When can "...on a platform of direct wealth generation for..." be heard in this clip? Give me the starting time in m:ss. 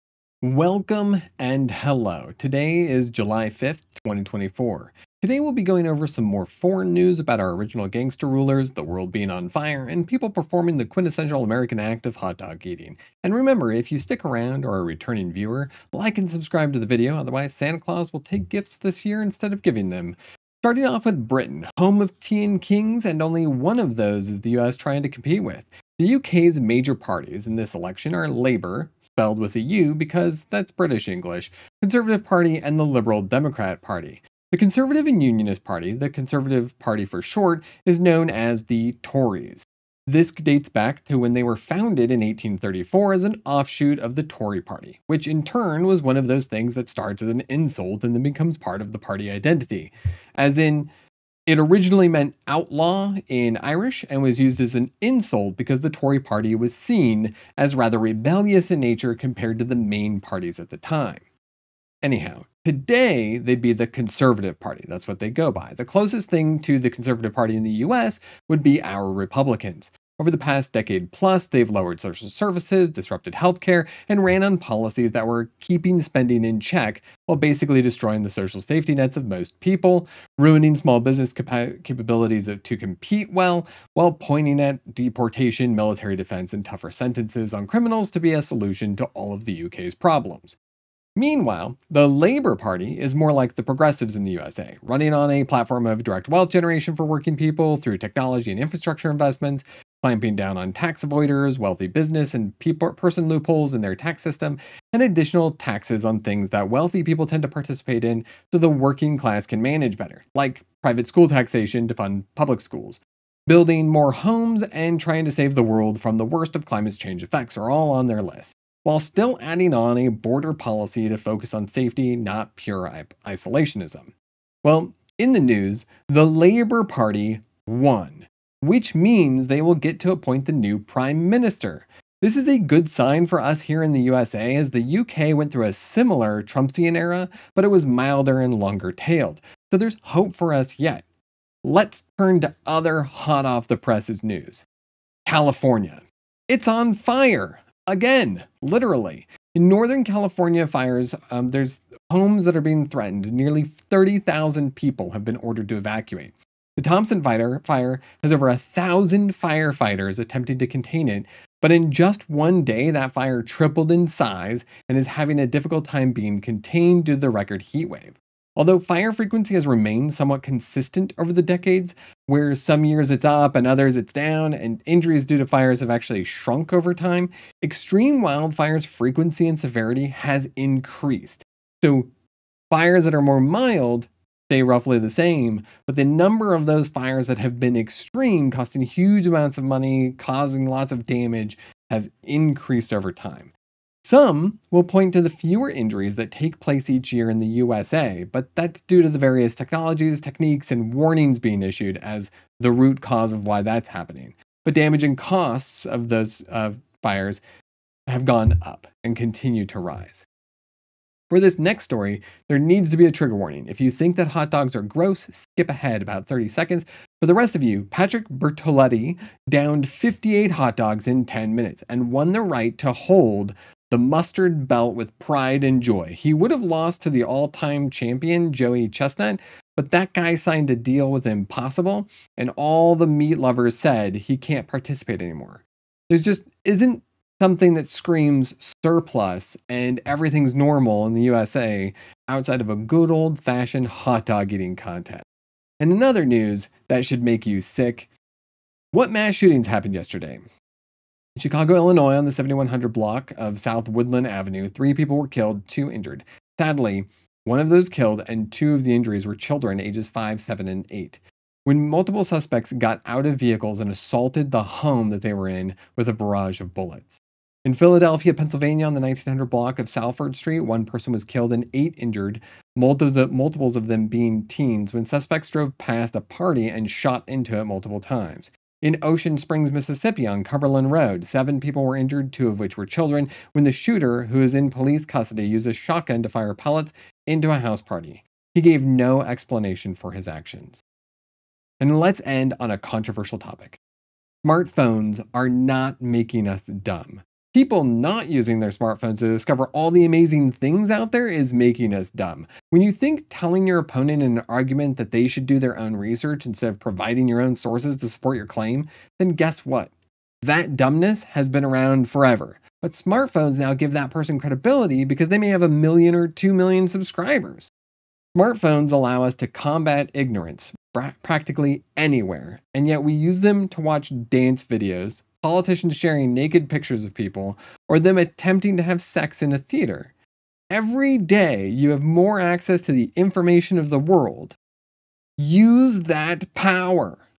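1:35.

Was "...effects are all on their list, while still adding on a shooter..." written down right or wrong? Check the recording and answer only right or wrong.
wrong.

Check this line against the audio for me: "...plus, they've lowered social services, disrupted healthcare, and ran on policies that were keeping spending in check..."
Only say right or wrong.
right.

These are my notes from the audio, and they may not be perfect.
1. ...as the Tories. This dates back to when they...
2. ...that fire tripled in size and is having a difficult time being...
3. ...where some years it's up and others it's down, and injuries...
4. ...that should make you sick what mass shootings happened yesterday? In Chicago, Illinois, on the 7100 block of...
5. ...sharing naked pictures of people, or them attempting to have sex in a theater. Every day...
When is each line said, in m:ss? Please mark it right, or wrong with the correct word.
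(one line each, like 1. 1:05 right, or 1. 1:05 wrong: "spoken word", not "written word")
1. 0:38 right
2. 2:42 right
3. 2:52 right
4. 4:06 right
5. 5:25 right.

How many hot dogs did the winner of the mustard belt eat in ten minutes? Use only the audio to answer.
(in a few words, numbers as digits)
58.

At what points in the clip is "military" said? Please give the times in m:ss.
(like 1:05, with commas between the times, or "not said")
1:25.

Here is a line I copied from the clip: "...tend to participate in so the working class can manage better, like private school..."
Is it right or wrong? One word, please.
right.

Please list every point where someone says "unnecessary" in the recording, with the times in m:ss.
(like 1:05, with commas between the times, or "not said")
not said.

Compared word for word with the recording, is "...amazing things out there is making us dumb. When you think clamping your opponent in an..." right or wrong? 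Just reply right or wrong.
wrong.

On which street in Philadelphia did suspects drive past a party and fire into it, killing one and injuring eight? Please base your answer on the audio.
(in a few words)
Salford Street.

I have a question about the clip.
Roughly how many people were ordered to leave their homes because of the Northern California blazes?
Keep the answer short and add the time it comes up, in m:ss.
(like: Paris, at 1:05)
30,000, at 2:33.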